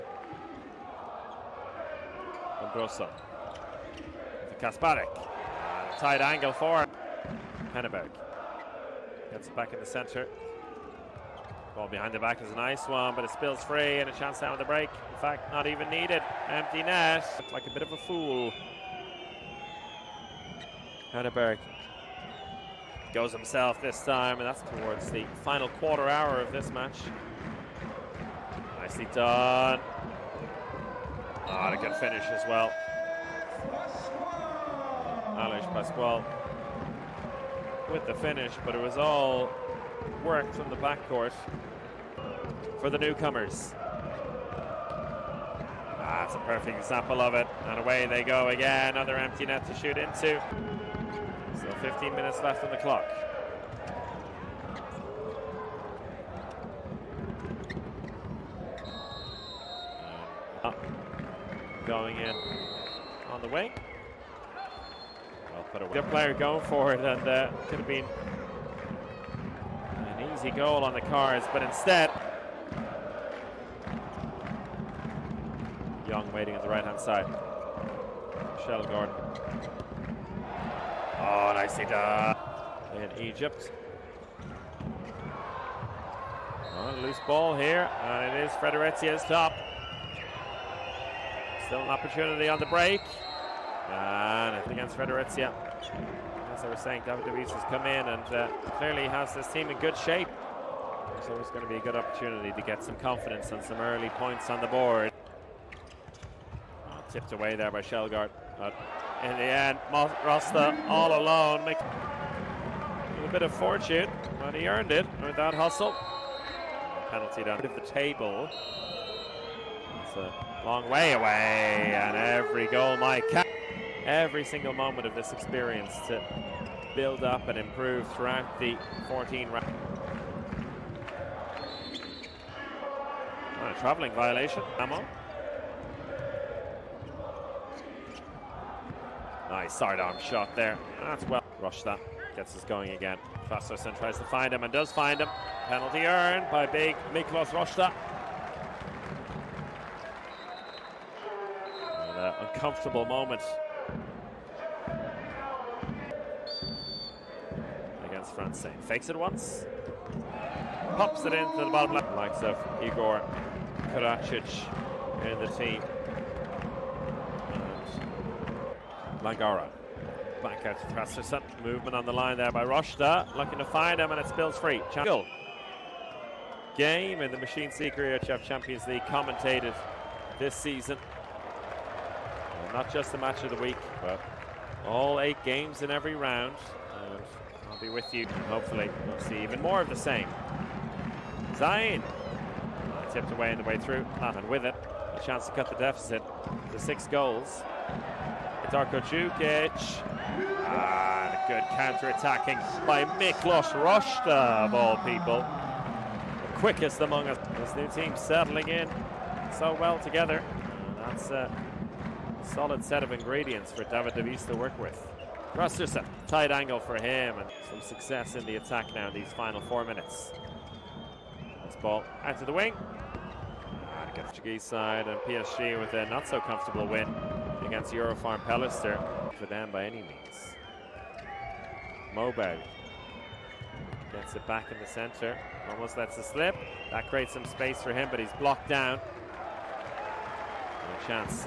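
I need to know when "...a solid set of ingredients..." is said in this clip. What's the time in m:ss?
3:31.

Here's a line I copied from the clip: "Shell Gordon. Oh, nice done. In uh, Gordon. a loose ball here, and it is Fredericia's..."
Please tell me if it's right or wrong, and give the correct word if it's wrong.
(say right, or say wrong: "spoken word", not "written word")
wrong: "Egypt", not "Gordon".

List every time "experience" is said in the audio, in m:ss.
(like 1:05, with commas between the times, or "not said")
2:05.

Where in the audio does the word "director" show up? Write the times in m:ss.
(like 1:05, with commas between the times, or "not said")
not said.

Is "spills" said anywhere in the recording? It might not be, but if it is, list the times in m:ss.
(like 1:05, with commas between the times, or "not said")
0:13, 2:54.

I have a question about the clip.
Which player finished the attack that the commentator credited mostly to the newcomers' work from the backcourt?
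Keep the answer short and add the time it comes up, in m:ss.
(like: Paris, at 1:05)
Alex Pascual, at 0:35.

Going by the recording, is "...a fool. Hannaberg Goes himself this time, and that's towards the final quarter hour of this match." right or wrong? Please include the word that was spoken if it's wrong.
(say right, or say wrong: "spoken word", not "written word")
right.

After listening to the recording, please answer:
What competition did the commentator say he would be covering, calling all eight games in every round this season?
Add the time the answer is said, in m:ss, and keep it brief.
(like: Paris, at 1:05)
Machineseeker Champions League, at 2:57.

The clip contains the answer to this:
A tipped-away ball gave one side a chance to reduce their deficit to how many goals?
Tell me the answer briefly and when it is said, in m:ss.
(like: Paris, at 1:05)
6, at 3:16.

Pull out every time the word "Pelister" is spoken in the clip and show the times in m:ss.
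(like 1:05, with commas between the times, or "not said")
3:48.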